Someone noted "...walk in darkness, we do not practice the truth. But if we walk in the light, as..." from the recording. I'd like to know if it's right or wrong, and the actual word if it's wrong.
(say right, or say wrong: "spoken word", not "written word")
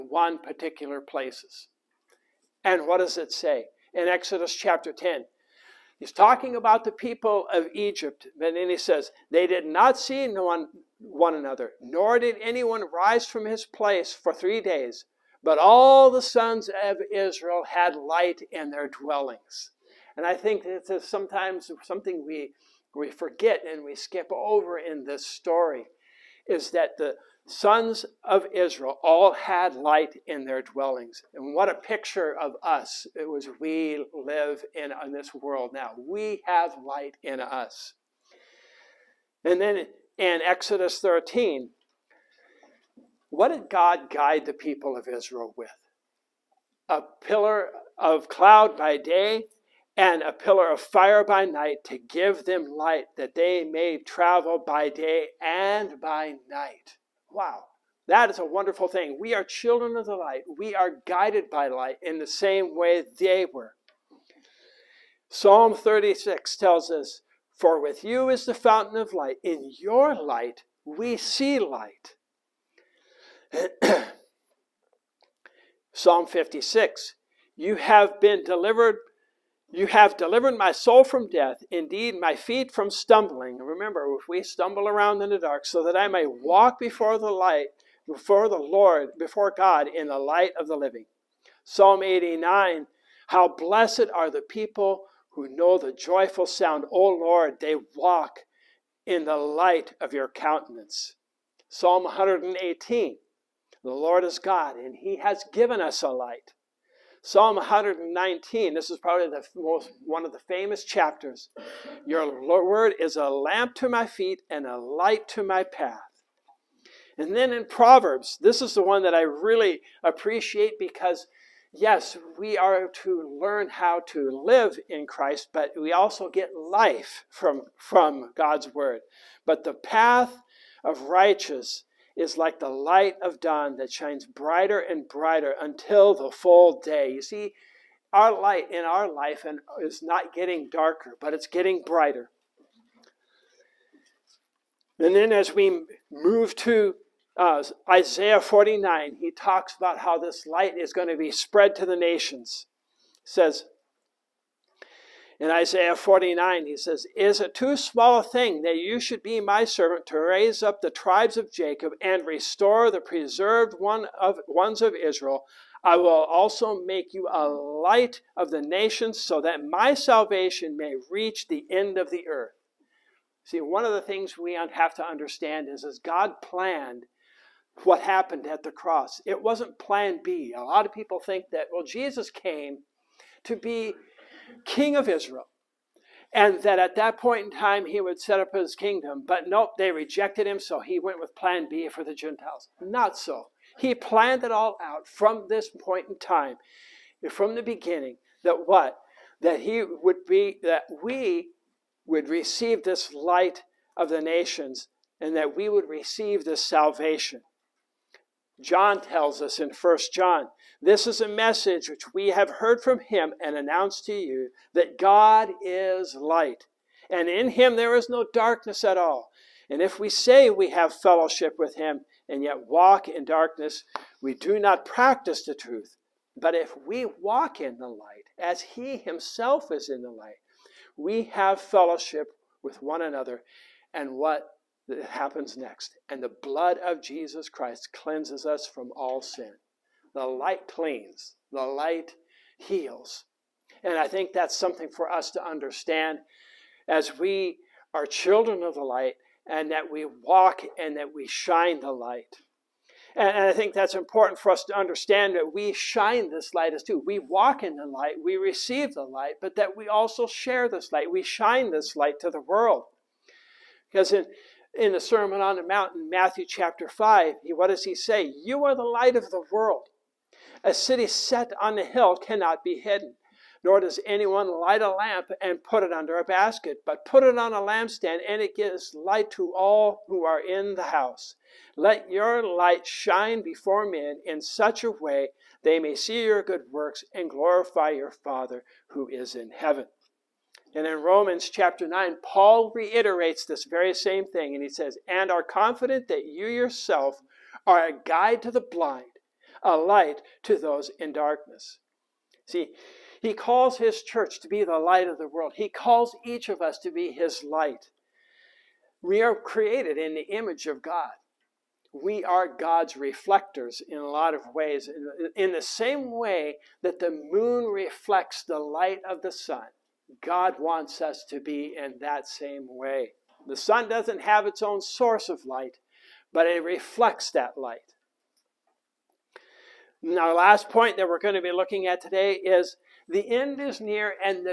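right.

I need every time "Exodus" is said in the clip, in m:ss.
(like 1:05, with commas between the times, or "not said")
0:04, 0:40.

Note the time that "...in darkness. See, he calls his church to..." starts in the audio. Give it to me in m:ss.
5:00.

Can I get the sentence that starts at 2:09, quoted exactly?
But the path of righteous is like the light of dawn that shines brighter and brighter until the full day.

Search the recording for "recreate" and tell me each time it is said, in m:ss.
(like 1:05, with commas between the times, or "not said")
not said.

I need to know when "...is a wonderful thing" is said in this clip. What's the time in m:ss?
0:58.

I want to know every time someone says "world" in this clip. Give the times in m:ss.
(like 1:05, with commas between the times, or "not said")
0:35, 4:22, 4:29, 5:05.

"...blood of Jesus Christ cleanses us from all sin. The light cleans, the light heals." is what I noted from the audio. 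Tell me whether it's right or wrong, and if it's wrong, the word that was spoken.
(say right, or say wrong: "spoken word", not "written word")
right.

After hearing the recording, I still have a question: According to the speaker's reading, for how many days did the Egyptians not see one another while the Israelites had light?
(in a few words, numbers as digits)
3 days.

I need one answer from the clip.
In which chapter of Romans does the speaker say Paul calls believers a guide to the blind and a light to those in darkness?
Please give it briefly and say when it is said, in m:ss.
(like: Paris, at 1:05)
9, at 4:51.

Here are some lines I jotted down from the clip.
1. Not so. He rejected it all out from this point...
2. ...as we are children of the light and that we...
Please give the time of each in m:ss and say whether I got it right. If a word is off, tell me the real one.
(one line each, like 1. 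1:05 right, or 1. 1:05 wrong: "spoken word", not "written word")
1. 3:12 wrong: "planned", not "rejected"
2. 4:06 right.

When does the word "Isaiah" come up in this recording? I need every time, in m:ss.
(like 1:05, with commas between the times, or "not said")
2:27, 2:35.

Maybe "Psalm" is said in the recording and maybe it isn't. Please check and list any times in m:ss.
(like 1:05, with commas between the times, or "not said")
1:05, 1:15, 1:31, 1:41, 1:47.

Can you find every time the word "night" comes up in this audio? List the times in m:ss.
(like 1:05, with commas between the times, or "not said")
0:51, 0:56.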